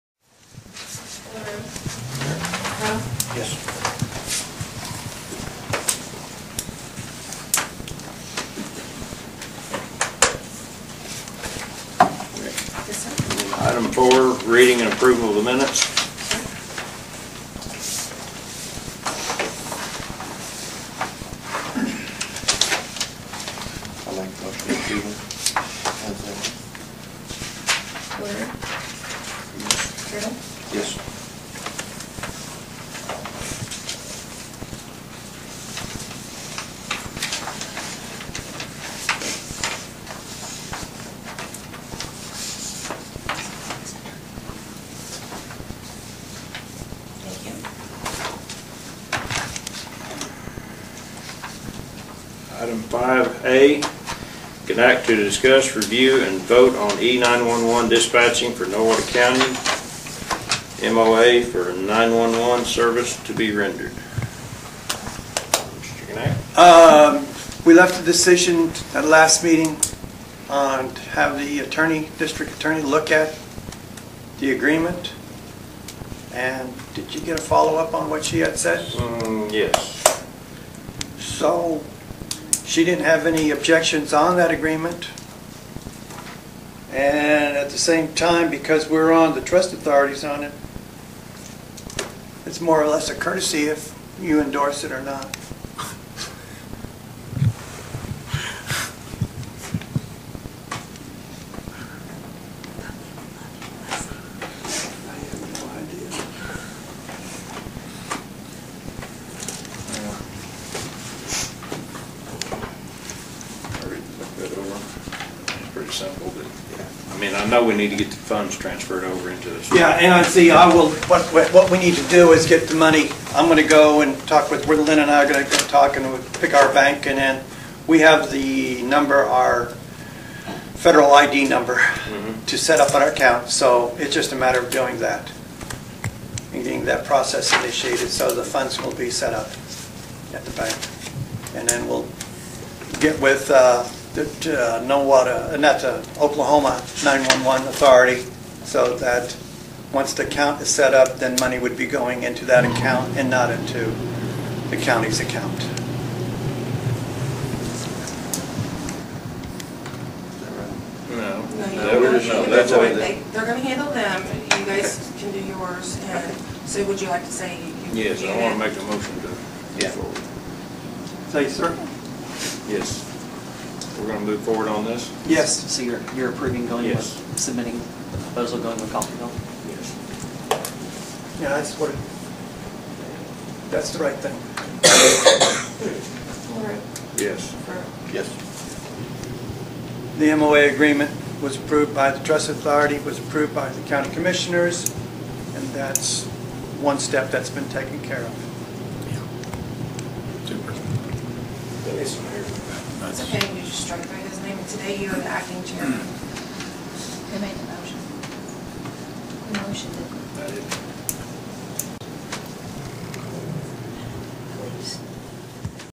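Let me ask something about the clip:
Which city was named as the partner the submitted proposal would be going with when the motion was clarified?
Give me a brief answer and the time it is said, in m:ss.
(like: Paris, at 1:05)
Coffeyville, at 2:58.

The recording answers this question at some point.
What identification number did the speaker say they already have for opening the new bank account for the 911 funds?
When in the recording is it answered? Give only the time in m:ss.
2:10.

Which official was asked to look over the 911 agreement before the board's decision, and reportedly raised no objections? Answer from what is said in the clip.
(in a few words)
district attorney.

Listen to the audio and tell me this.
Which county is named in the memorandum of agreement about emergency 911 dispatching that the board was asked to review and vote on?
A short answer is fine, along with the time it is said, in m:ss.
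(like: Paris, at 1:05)
Nowata County, at 0:58.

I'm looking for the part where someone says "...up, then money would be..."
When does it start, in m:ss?
2:30.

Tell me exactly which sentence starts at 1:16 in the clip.
And did you get a follow-up on what she had said?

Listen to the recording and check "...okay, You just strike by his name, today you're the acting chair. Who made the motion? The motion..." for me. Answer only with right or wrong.
right.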